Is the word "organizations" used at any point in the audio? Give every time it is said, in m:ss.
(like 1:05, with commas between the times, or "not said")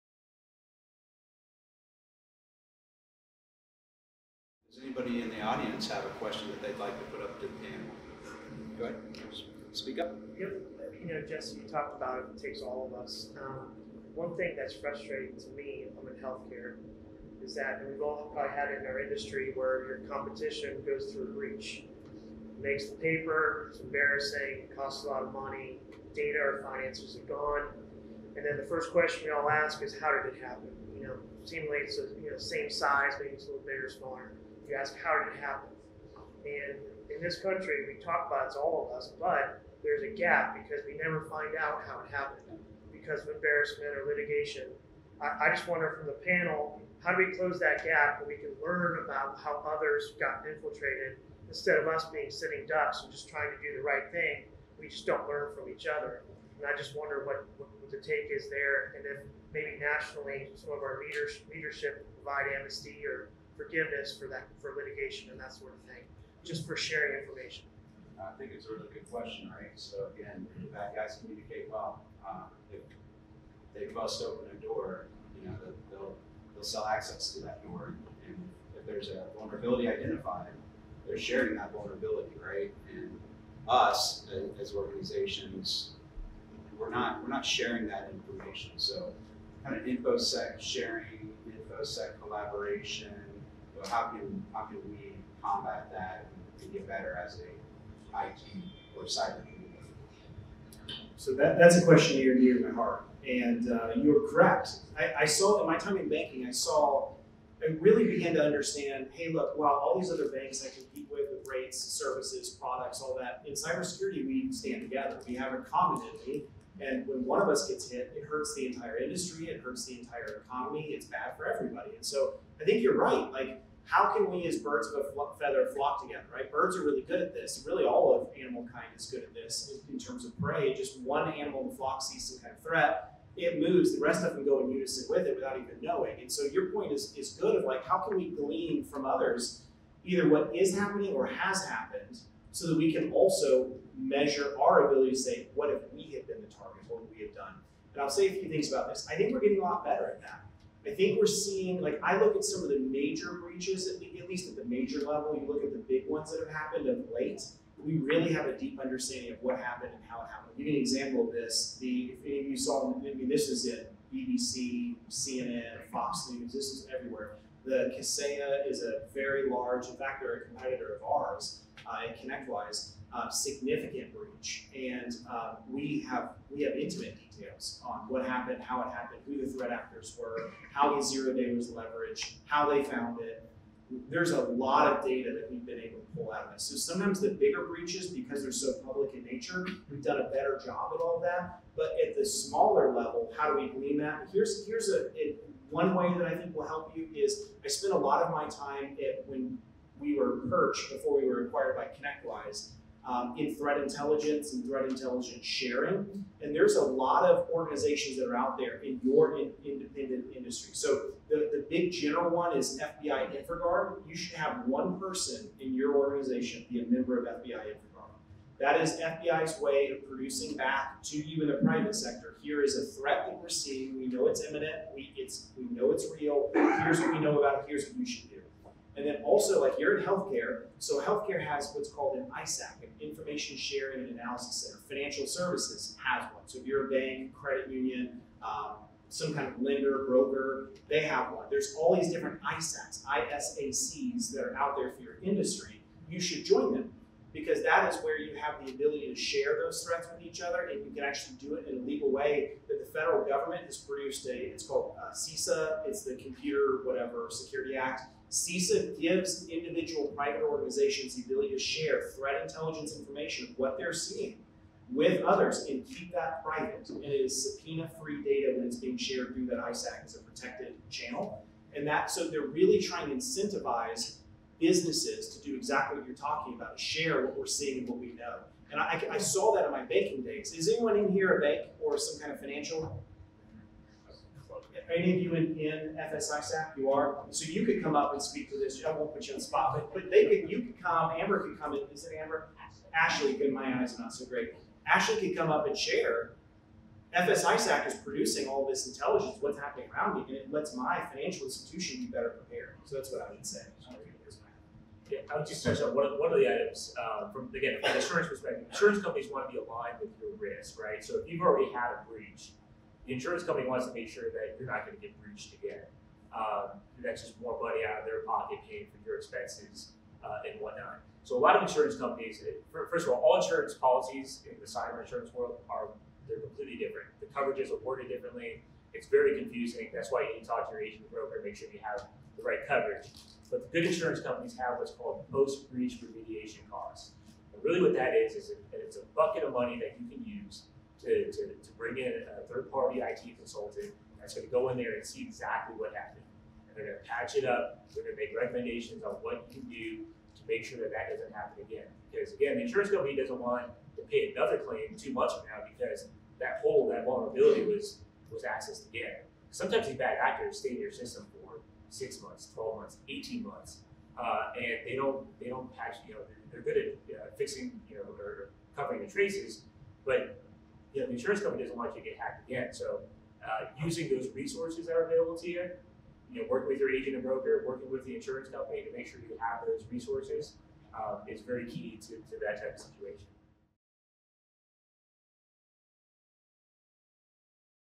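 1:24, 3:27, 3:35, 4:20.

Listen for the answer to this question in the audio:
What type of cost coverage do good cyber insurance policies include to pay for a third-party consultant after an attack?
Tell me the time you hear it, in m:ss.
5:35.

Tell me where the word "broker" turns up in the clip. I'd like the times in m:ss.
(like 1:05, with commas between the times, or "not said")
4:00, 5:31, 6:17.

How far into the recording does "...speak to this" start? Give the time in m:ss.
4:48.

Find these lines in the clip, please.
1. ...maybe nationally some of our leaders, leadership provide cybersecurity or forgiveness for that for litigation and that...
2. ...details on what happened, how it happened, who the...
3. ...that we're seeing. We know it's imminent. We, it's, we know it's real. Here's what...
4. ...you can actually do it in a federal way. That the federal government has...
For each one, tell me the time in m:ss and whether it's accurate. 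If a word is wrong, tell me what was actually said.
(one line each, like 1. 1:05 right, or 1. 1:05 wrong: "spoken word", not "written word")
1. 0:59 wrong: "amnesty", not "cybersecurity"
2. 2:57 right
3. 3:43 right
4. 4:10 wrong: "legal", not "federal".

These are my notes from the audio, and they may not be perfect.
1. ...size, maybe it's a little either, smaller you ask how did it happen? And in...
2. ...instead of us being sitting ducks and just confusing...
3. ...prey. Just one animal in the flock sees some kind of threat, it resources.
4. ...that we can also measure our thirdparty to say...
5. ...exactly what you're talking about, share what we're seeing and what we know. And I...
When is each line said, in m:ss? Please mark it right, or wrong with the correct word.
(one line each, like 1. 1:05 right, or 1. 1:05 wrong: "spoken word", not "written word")
1. 0:32 wrong: "bigger", not "either"
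2. 0:51 wrong: "trying", not "confusing"
3. 2:10 wrong: "moves", not "resources"
4. 2:22 wrong: "ability", not "thirdparty"
5. 4:35 right.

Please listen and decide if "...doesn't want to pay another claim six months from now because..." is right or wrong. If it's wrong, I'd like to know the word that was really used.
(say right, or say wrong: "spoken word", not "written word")
wrong: "two", not "six".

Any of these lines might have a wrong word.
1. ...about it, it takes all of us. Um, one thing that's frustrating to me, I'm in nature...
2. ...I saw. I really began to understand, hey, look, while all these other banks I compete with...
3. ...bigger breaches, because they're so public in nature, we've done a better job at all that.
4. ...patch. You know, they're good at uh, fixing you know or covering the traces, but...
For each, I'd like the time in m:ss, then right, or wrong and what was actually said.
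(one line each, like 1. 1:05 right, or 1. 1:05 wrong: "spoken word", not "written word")
1. 0:11 wrong: "healthcare", not "nature"
2. 1:46 right
3. 3:07 right
4. 6:05 right.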